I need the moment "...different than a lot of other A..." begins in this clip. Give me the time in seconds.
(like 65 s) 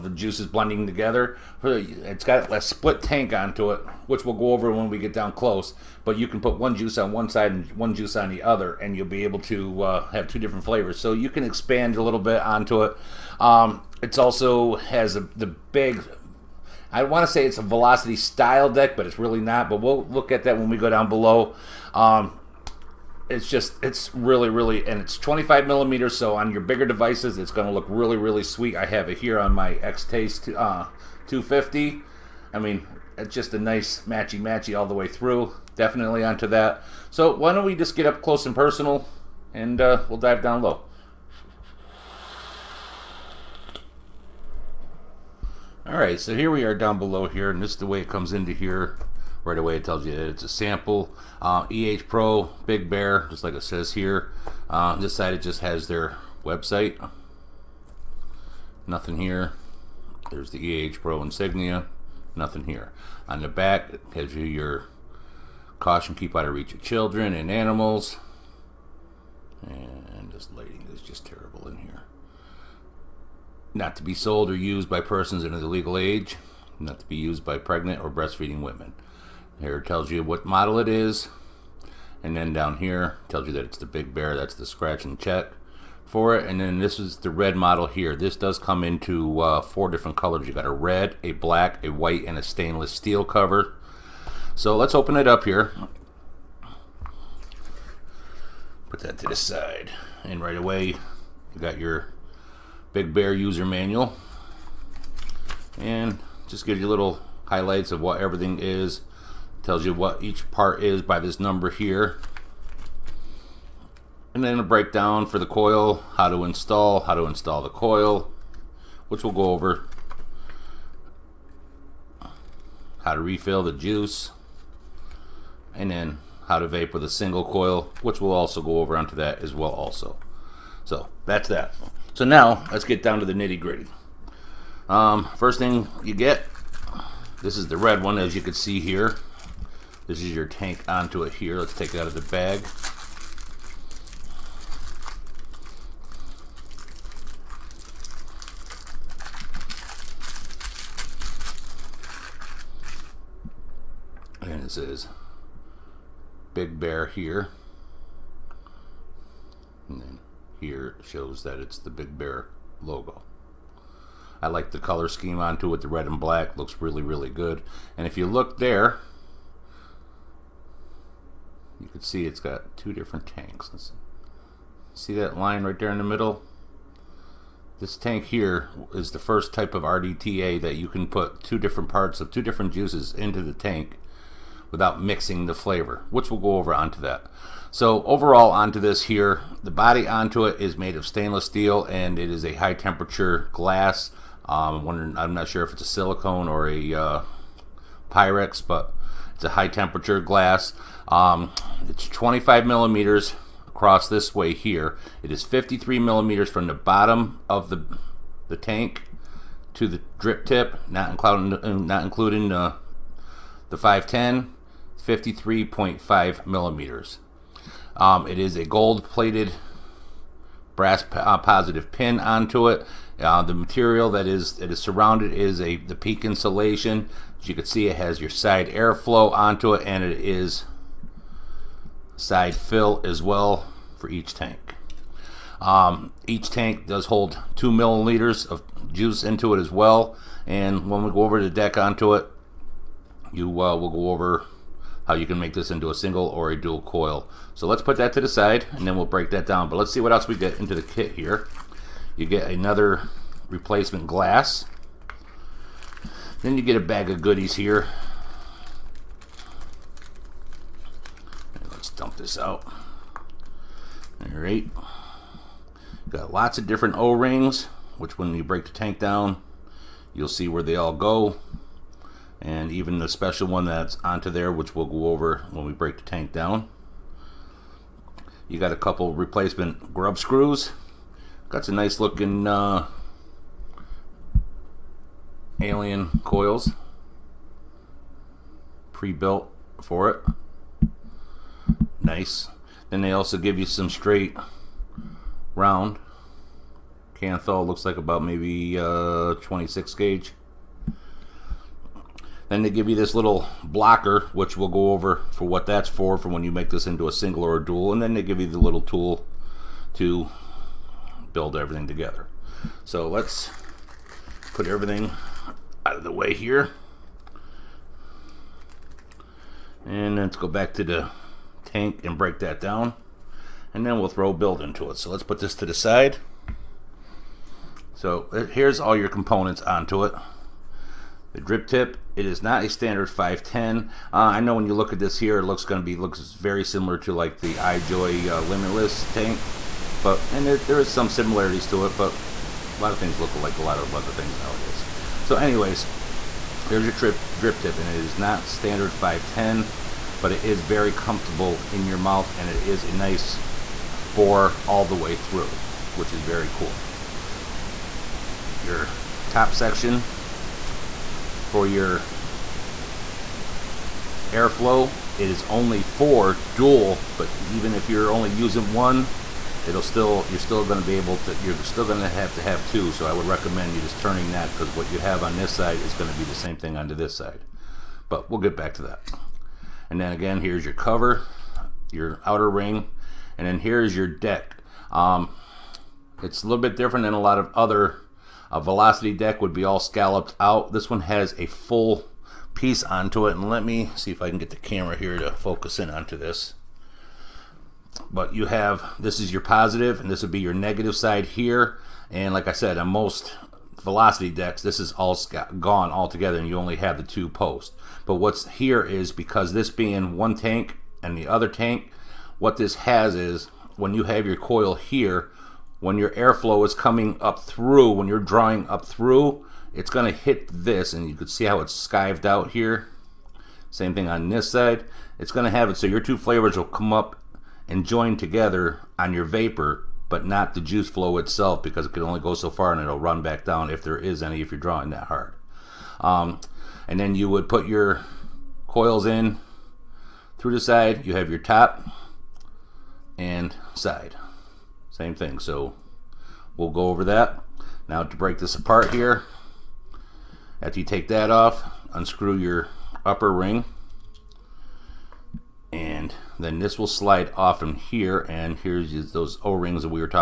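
386 s.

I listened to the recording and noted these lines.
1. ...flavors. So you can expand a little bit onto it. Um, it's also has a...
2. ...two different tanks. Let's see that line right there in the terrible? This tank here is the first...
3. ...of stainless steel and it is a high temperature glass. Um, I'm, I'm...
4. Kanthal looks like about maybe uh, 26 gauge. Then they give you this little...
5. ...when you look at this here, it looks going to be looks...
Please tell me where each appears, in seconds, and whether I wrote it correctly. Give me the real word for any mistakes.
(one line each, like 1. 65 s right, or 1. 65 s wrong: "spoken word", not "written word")
1. 10 s right
2. 172 s wrong: "middle", not "terrible"
3. 190 s right
4. 297 s right
5. 334 s right.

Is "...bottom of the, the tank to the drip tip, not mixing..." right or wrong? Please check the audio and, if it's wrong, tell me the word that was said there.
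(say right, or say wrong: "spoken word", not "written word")
wrong: "including", not "mixing".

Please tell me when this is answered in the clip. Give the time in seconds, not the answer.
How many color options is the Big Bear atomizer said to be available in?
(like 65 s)
89 s.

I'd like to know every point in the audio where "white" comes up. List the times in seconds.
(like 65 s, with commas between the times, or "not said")
91 s.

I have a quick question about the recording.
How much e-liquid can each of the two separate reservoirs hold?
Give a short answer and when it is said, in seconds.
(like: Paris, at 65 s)
2 milliliters, at 237 s.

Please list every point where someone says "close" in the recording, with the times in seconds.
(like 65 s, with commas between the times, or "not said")
5 s, 38 s.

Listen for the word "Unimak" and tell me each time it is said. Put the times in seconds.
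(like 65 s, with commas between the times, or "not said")
not said.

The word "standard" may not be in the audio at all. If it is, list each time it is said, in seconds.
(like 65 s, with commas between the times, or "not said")
332 s, 348 s.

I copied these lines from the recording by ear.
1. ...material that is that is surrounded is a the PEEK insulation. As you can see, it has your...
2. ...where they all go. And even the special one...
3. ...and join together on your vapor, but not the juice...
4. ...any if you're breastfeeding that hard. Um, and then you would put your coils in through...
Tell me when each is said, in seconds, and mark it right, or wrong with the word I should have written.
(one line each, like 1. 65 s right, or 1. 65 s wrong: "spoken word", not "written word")
1. 223 s right
2. 270 s right
3. 427 s right
4. 434 s wrong: "drawing", not "breastfeeding".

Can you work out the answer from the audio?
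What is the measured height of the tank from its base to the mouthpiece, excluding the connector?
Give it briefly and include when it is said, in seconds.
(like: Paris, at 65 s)
53.5 millimeters, at 215 s.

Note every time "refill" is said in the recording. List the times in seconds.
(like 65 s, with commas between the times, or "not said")
123 s.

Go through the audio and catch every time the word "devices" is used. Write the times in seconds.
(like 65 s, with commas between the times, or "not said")
26 s.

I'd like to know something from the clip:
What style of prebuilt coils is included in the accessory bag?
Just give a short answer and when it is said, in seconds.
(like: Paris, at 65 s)
alien coils, at 285 s.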